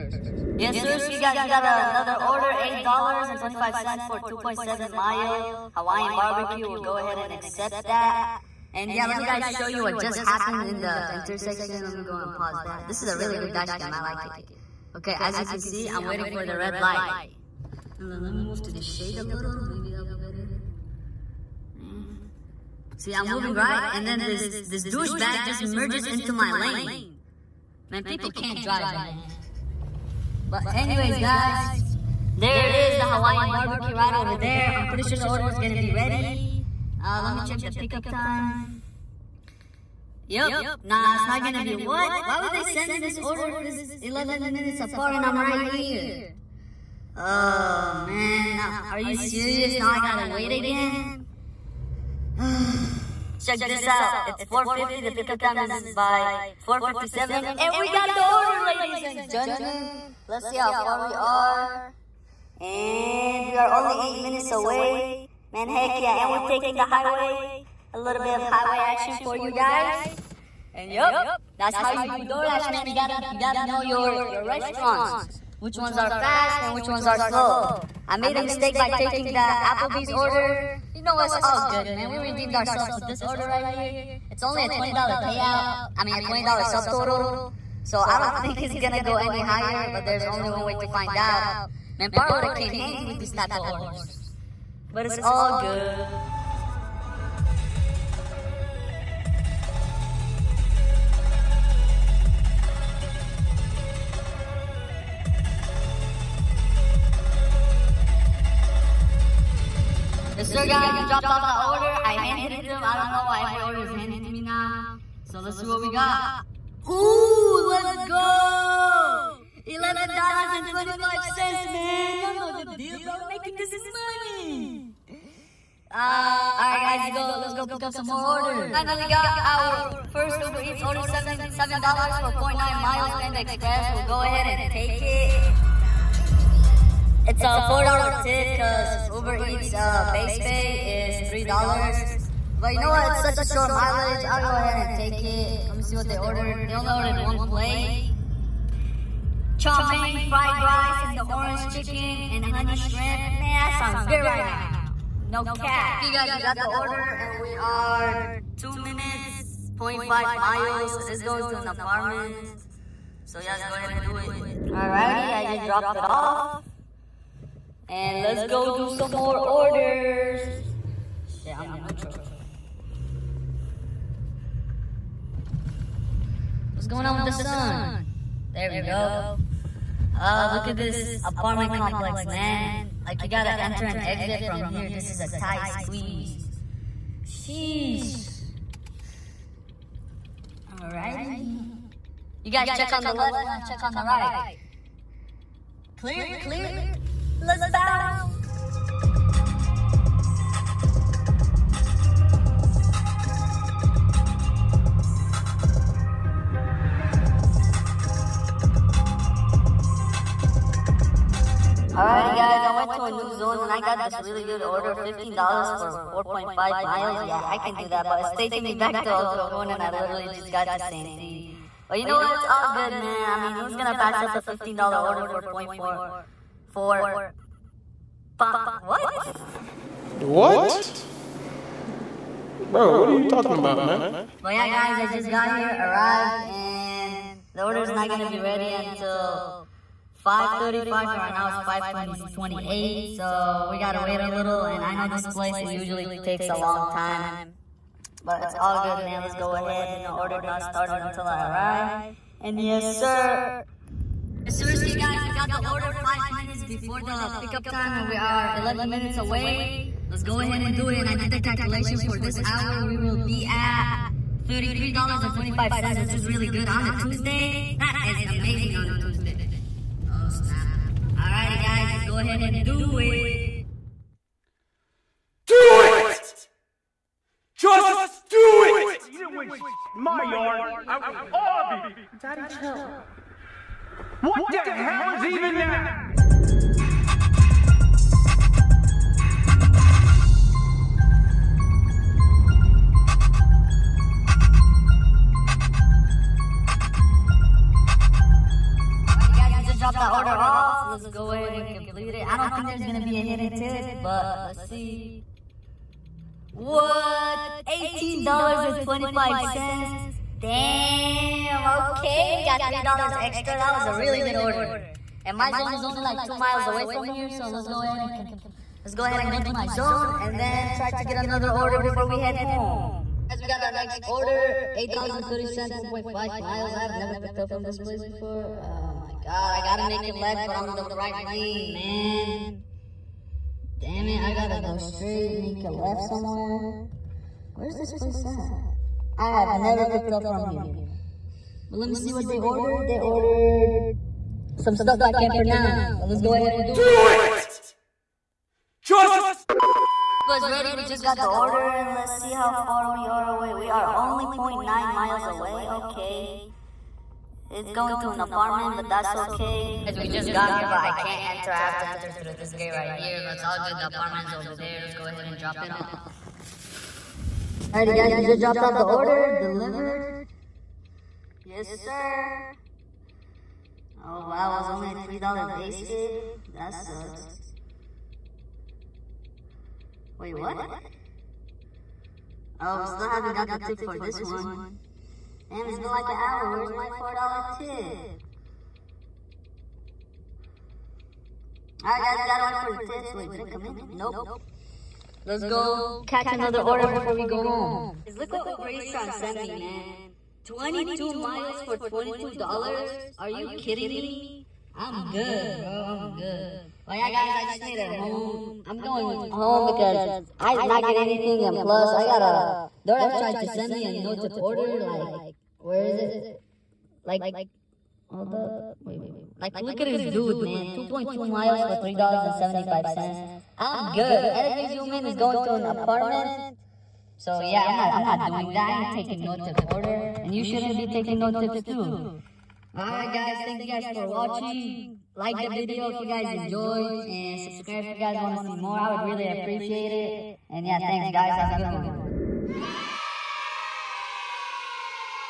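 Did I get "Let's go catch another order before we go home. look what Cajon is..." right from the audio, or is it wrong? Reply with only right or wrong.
wrong.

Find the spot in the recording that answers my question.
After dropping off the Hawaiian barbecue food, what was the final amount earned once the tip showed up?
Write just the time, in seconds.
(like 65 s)
119 s.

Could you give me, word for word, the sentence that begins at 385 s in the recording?
Damn, it's been like an hour.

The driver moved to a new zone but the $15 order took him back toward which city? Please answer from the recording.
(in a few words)
El Cajon.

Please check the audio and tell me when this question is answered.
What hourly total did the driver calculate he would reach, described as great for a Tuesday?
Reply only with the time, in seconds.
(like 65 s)
264 s.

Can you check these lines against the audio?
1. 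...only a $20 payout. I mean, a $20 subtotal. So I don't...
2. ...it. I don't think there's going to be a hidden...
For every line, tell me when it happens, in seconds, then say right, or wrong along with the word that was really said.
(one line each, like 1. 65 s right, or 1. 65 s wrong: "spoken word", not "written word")
1. 84 s right
2. 302 s right.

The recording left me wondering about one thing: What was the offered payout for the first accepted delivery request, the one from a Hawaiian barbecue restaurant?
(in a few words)
$8.25.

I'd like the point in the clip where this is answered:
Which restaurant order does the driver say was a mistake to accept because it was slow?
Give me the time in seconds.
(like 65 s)
79 s.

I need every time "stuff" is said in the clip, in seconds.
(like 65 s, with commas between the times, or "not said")
344 s.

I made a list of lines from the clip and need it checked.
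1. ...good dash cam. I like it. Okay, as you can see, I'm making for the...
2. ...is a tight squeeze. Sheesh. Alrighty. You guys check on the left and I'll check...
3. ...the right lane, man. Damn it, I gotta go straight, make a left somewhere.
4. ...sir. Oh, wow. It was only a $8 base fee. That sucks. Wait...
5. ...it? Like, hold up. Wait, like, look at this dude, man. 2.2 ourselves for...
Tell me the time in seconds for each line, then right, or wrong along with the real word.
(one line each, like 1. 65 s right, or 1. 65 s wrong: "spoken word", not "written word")
1. 13 s wrong: "waiting", not "making"
2. 185 s right
3. 330 s right
4. 371 s wrong: "3", not "8"
5. 415 s wrong: "miles", not "ourselves".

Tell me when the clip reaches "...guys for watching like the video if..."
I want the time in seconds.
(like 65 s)
433 s.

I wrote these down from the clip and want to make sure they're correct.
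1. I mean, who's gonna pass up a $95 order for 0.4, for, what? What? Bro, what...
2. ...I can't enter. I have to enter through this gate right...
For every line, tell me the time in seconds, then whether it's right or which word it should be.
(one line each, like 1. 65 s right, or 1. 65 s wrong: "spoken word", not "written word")
1. 223 s wrong: "15", not "95"
2. 360 s right.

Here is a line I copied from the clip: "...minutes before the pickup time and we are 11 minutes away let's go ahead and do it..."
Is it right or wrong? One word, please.
right.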